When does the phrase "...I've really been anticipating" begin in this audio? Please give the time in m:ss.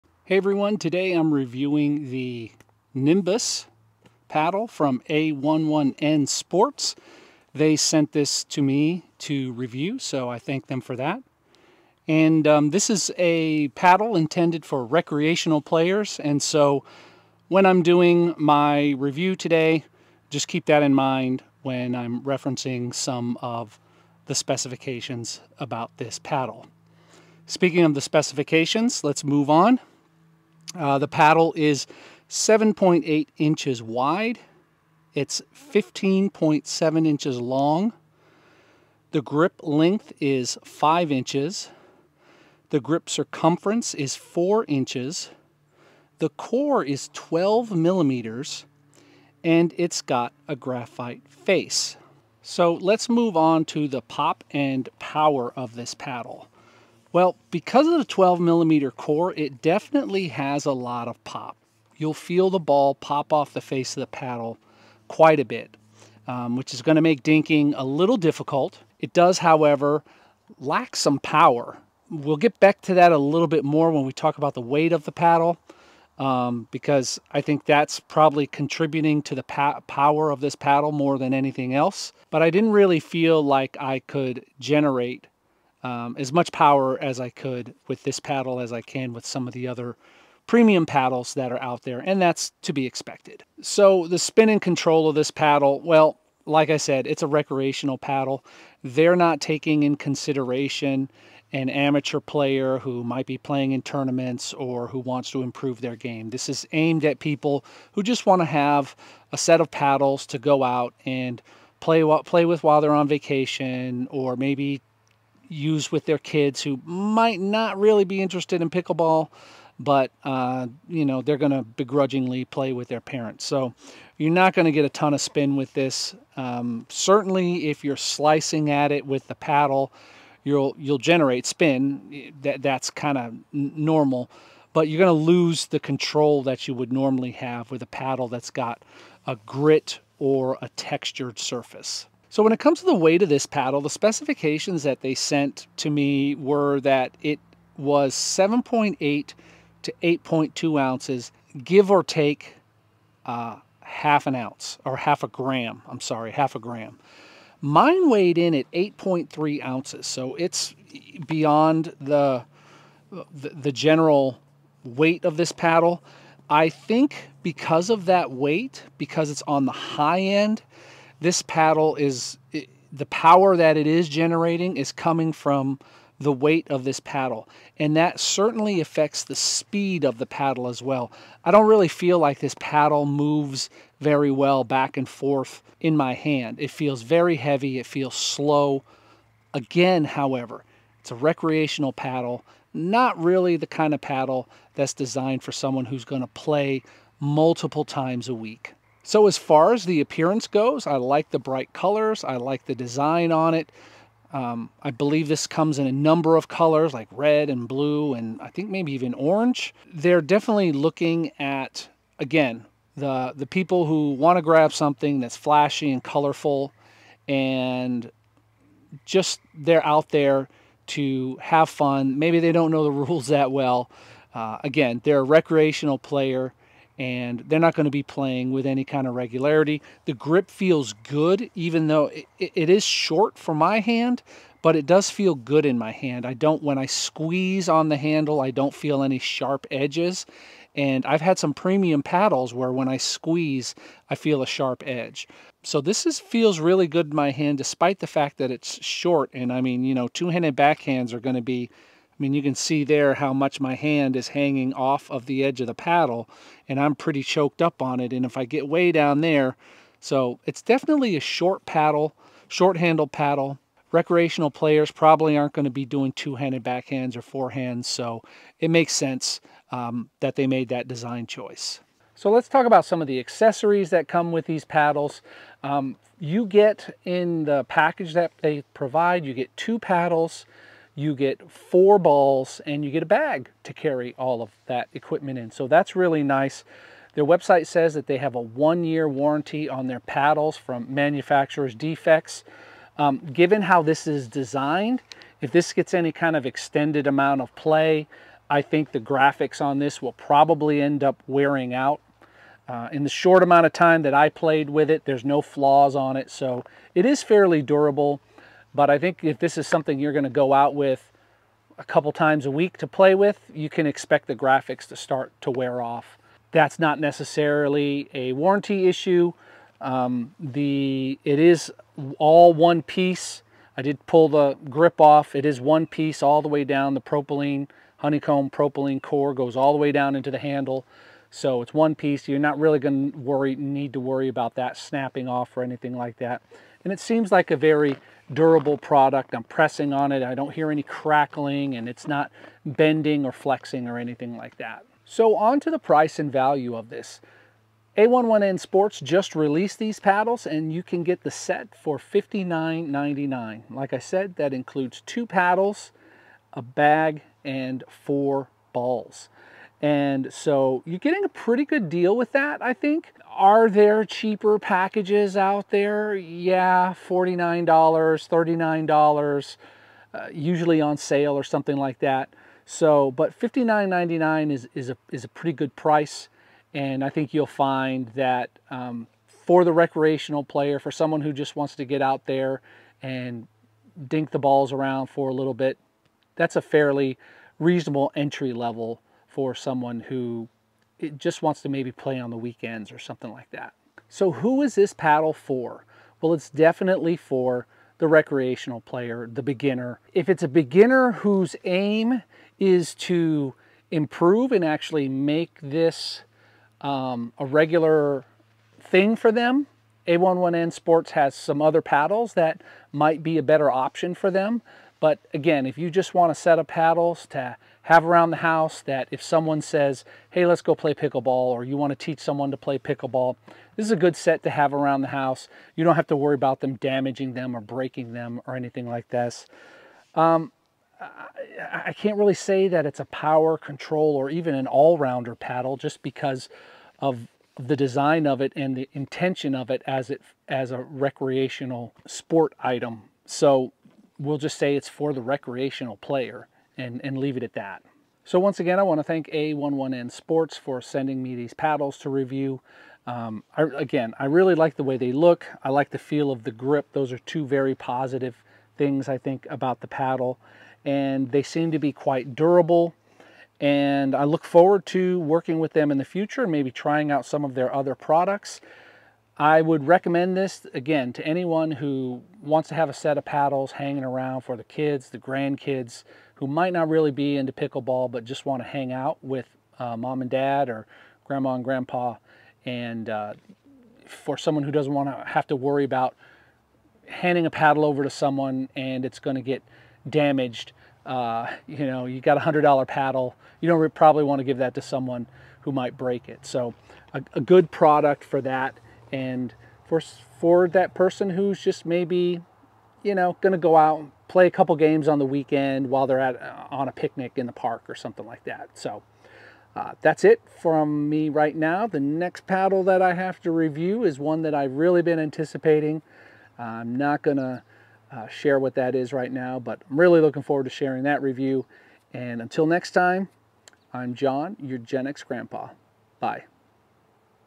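8:34.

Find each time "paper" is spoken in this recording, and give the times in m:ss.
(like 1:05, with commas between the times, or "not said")
not said.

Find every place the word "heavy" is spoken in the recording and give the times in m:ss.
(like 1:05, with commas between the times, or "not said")
3:07.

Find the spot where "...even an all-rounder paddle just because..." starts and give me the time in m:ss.
7:14.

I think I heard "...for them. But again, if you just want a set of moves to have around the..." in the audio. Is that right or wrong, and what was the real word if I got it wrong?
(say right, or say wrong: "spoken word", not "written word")
wrong: "paddles", not "moves".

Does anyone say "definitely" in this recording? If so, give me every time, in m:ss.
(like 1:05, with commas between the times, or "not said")
0:59, 3:30, 4:20, 6:36.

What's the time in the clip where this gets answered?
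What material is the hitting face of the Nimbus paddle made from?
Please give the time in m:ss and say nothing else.
0:50.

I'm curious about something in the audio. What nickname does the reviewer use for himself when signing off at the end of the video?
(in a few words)
Gen X grandpa.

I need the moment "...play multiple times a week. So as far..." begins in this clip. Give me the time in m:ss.
3:16.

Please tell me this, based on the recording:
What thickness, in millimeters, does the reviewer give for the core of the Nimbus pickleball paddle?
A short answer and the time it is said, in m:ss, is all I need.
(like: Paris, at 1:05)
12 millimeters, at 0:46.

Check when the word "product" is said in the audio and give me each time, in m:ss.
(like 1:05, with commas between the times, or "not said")
5:38, 7:47, 8:17.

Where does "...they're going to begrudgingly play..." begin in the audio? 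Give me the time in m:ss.
2:01.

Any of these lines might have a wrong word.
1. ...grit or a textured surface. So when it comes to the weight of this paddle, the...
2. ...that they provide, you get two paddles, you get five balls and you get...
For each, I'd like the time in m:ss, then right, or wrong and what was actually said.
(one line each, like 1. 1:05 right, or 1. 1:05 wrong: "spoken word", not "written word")
1. 2:19 right
2. 4:38 wrong: "four", not "five".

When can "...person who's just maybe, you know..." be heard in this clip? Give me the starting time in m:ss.
8:20.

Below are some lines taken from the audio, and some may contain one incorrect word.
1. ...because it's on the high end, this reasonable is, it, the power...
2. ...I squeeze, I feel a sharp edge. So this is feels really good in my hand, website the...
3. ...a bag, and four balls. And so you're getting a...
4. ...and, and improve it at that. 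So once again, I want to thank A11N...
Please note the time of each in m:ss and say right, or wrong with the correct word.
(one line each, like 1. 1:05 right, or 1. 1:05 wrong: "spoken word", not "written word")
1. 2:48 wrong: "paddle", not "reasonable"
2. 4:02 wrong: "despite", not "website"
3. 5:56 right
4. 7:26 wrong: "leave", not "improve".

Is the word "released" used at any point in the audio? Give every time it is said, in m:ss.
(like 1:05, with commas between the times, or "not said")
5:49.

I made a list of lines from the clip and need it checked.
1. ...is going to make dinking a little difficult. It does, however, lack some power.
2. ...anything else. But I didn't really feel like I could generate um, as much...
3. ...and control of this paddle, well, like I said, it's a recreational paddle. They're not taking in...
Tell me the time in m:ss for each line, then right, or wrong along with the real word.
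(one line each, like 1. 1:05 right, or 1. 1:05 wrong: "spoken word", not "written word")
1. 1:06 right
2. 1:21 right
3. 1:34 right.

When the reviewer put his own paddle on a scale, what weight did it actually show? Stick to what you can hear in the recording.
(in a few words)
8.3 ounces.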